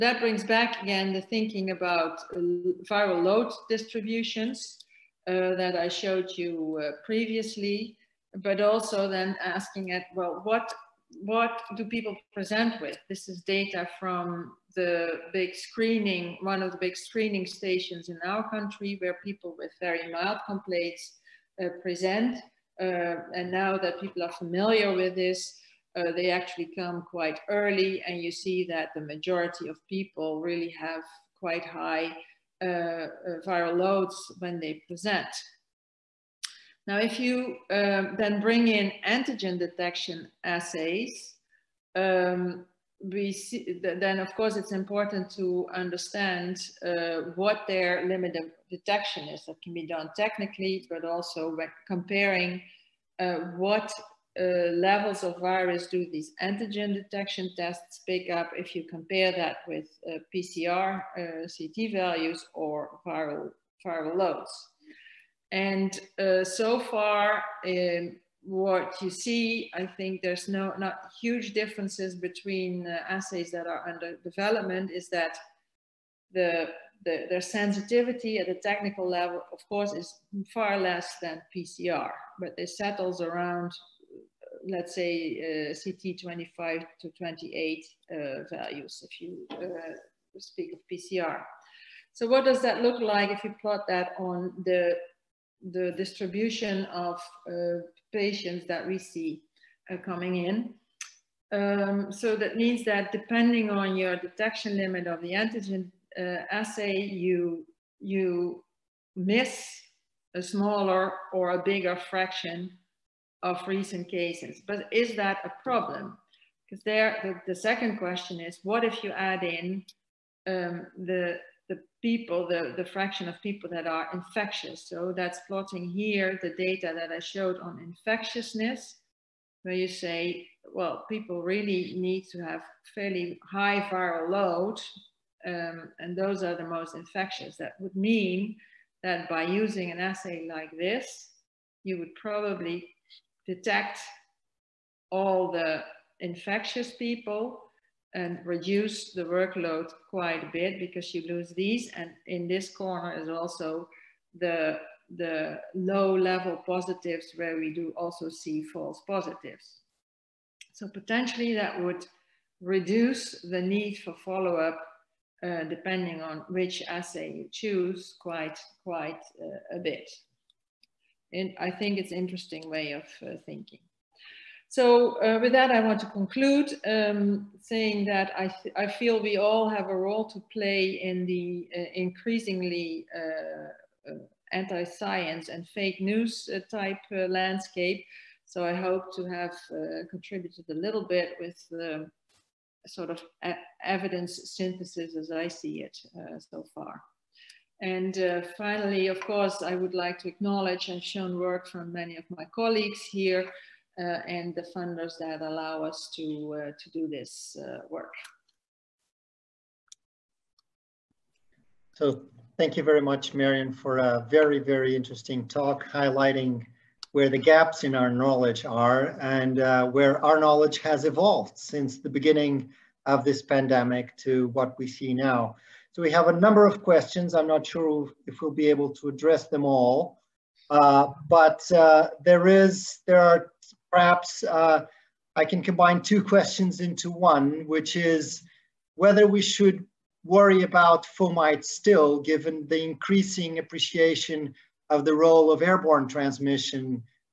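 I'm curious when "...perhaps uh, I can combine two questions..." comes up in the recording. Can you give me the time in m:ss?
3:53.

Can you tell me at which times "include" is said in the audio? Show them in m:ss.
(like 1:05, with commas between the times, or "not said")
not said.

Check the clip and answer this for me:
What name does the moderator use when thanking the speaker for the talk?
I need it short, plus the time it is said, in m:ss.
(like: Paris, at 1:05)
Marion, at 3:33.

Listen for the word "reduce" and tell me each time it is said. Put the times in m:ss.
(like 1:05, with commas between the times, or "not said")
2:28, 2:42.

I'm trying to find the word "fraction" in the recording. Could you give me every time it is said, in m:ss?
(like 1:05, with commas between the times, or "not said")
1:52, 2:02.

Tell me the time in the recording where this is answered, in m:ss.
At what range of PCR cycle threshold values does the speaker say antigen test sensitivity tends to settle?
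1:26.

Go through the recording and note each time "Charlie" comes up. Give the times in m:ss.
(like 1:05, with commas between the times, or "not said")
not said.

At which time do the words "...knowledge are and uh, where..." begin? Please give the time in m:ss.
3:38.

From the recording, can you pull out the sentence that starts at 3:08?
So I hope to have contributed a little bit with the sort of evidence synthesis as I see it so far.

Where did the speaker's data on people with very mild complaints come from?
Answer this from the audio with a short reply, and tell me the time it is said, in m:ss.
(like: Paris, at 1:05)
screening stations, at 0:16.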